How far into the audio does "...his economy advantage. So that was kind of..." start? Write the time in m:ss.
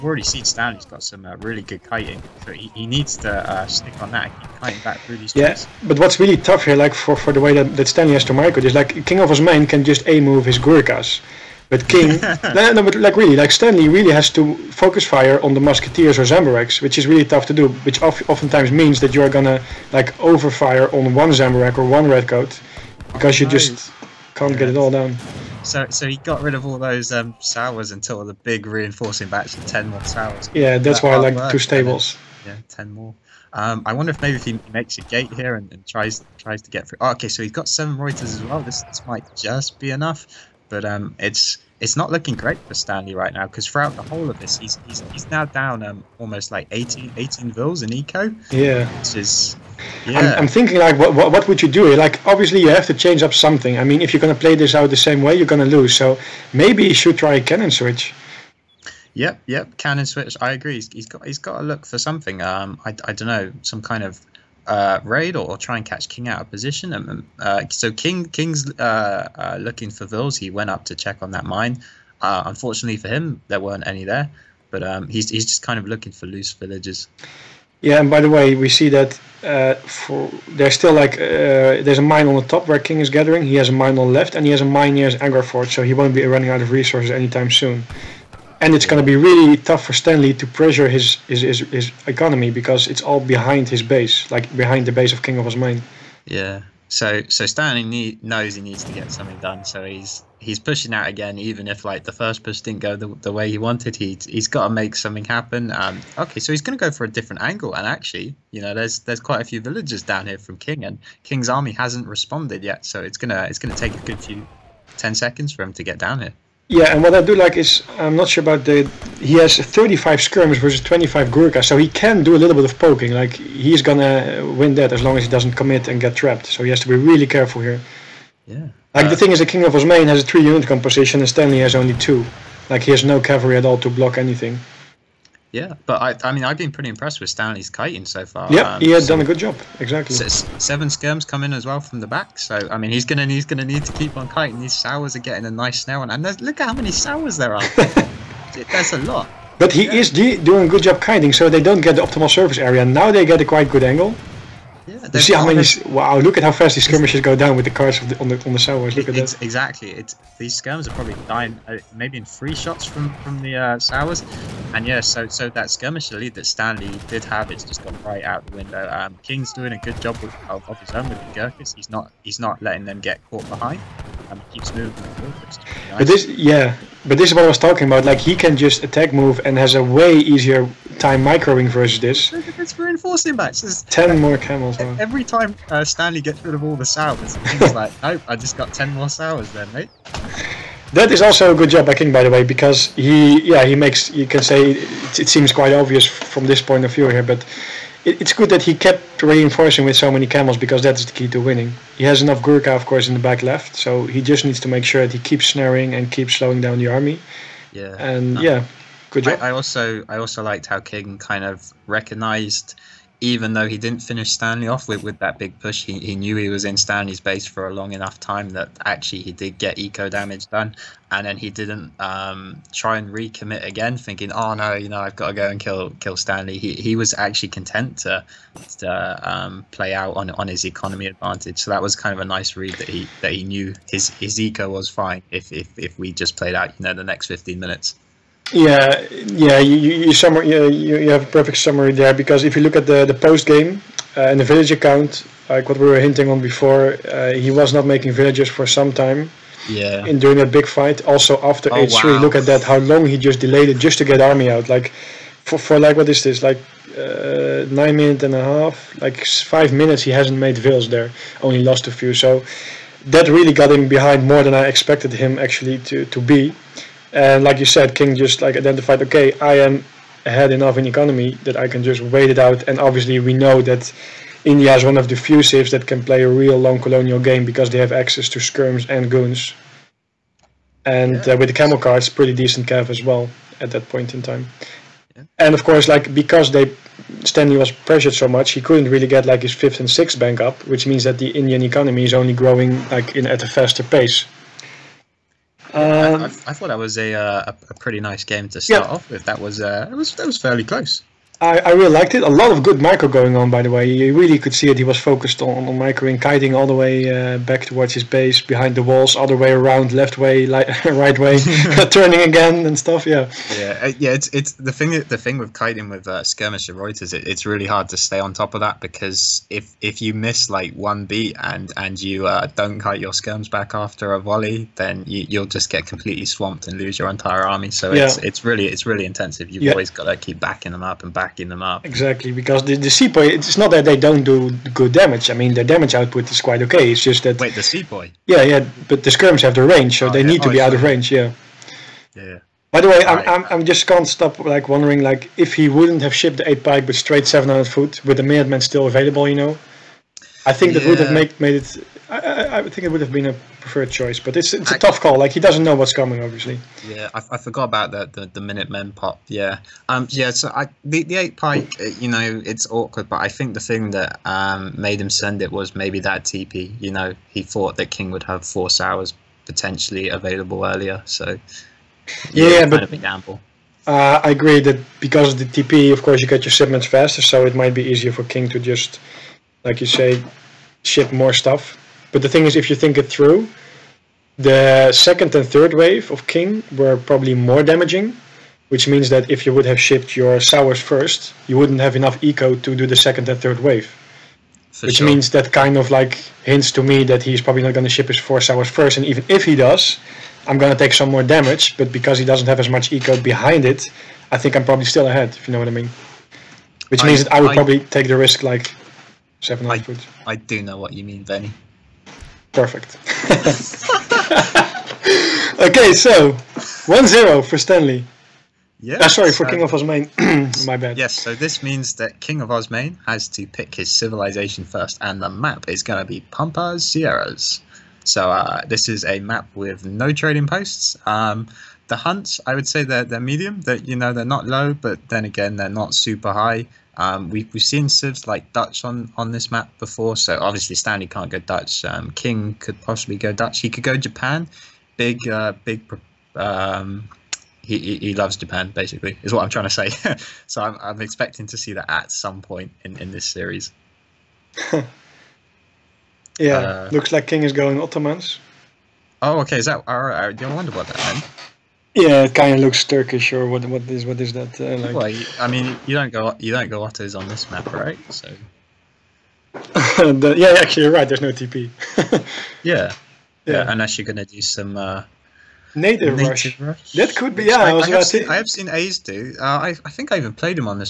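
3:50.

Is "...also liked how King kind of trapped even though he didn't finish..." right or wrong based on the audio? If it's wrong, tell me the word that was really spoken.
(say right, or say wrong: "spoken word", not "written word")
wrong: "recognized", not "trapped".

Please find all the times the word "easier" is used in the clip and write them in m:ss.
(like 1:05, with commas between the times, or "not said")
3:00, 6:17.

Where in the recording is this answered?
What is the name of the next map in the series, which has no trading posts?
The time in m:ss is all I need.
7:06.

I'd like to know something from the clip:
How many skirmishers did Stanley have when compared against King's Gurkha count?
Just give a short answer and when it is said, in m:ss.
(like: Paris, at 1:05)
35, at 1:59.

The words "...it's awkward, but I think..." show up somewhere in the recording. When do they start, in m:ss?
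6:02.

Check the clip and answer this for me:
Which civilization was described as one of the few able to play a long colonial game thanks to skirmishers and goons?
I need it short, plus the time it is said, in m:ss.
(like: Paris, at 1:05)
India, at 4:34.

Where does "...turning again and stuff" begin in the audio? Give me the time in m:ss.
5:11.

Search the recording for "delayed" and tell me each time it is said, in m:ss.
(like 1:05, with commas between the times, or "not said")
4:13.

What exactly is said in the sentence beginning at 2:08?
Like uh, the thing is, the King of Osmane has a three-unit composition, and Stanley has only two.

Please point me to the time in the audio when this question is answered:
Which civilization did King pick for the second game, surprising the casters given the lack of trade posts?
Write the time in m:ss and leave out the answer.
7:37.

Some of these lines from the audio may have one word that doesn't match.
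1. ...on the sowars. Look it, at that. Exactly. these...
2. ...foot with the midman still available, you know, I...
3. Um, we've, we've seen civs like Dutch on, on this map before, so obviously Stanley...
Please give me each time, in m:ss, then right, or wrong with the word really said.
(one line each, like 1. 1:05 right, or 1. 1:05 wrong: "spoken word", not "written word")
1. 2:38 right
2. 5:47 right
3. 7:16 right.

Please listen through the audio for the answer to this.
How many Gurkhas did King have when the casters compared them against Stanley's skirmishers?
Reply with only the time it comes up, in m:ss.
2:00.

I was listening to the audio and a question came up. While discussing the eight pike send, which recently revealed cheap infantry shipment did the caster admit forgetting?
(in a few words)
Minutemen.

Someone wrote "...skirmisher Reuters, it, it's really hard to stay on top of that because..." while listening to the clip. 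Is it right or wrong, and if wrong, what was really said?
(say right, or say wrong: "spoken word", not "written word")
right.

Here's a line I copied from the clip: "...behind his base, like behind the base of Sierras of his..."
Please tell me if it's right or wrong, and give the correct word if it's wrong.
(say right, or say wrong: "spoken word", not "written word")
wrong: "King", not "Sierras".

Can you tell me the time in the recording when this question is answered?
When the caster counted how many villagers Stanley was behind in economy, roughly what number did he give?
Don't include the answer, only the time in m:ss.
0:47.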